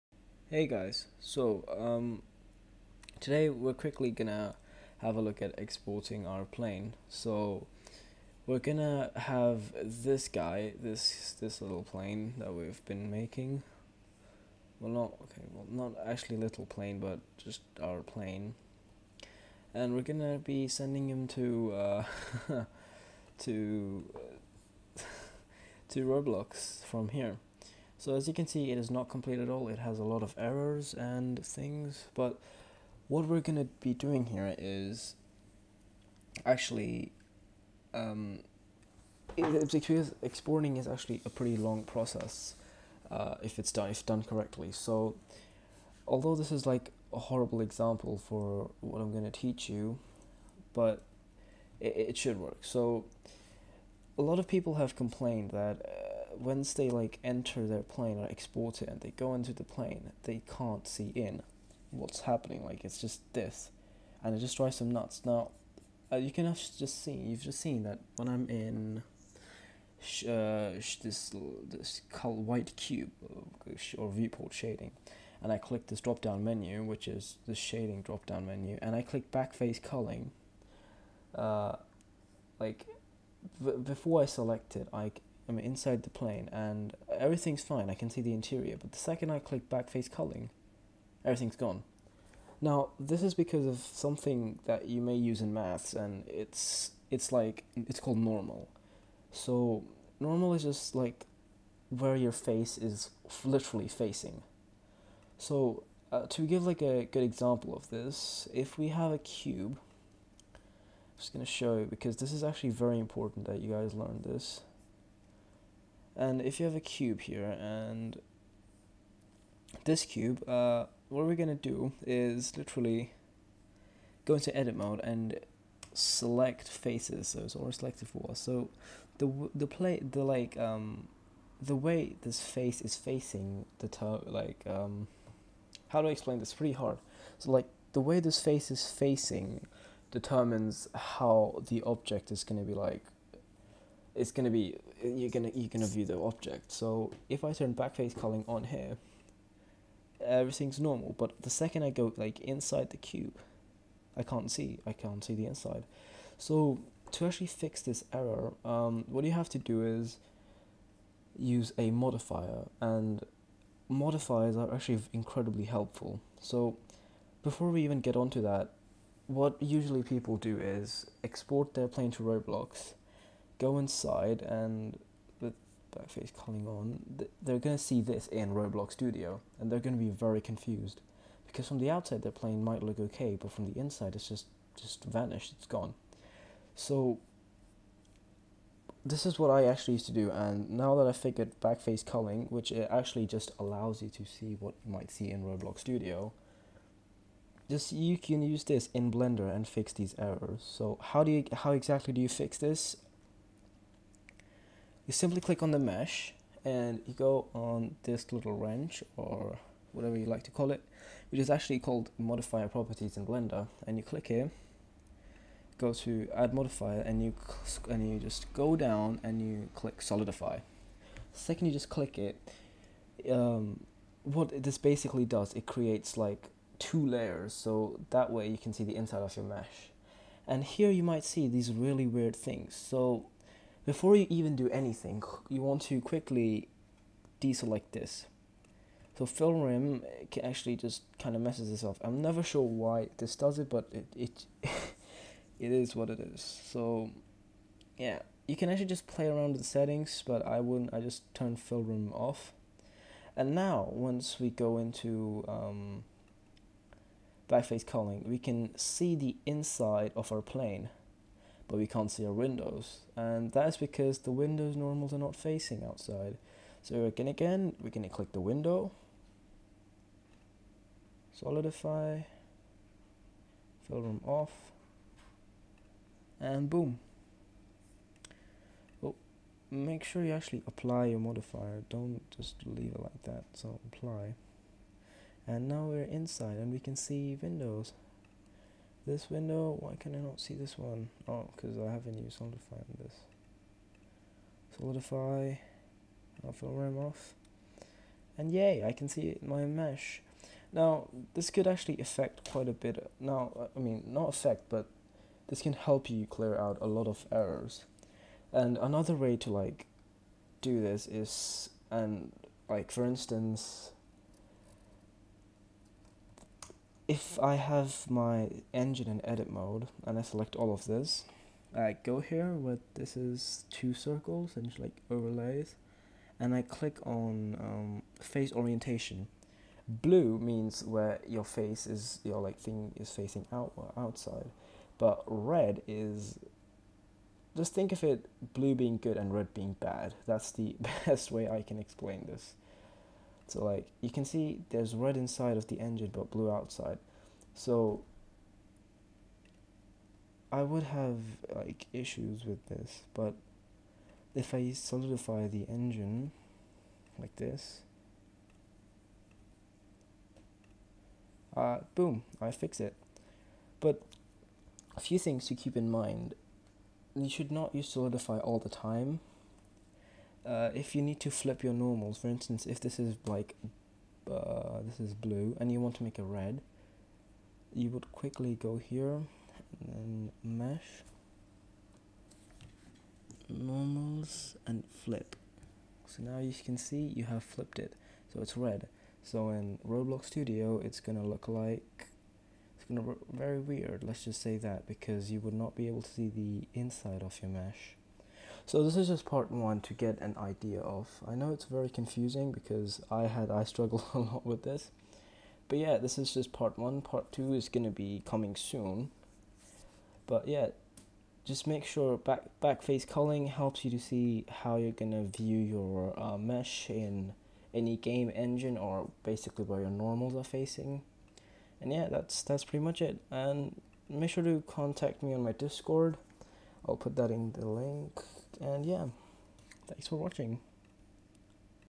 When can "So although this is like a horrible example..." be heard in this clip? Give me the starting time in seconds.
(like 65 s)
44 s.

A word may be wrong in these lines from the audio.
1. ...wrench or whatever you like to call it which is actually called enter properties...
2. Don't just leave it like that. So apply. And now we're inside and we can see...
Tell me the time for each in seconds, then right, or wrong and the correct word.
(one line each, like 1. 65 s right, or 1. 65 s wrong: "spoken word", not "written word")
1. 208 s wrong: "modifier", not "enter"
2. 281 s right.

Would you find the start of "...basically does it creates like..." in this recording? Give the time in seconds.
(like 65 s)
224 s.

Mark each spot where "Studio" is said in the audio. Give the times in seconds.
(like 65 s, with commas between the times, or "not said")
178 s, 195 s, 390 s.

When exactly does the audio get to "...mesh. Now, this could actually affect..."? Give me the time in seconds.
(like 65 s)
299 s.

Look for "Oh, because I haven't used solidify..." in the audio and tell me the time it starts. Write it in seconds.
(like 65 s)
291 s.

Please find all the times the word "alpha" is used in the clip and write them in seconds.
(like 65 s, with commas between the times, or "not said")
296 s.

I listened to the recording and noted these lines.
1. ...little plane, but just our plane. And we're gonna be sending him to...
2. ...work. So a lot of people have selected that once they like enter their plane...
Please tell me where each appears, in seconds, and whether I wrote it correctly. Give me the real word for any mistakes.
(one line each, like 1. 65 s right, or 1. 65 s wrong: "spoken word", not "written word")
1. 16 s right
2. 52 s wrong: "complained", not "selected".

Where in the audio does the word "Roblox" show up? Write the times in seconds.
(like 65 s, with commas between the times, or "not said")
26 s, 172 s, 178 s, 195 s, 389 s.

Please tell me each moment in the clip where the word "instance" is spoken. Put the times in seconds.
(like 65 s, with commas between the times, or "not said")
313 s, 372 s.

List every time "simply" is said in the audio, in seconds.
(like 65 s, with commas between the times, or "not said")
205 s.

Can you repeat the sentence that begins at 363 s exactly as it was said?
But a few things to keep in mind.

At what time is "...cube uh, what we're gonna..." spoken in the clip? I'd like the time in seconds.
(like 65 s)
120 s.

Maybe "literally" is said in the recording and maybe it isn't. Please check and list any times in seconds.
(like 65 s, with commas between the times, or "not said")
103 s, 122 s.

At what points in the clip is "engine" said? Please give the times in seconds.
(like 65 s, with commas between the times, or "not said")
318 s, 345 s, 355 s, 418 s.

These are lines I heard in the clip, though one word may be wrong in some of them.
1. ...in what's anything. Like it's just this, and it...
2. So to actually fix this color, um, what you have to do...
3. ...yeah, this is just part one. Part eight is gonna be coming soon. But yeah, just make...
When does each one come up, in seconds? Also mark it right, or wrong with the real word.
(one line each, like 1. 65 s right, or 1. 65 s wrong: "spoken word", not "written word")
1. 61 s wrong: "happening", not "anything"
2. 156 s wrong: "error", not "color"
3. 405 s wrong: "two", not "eight".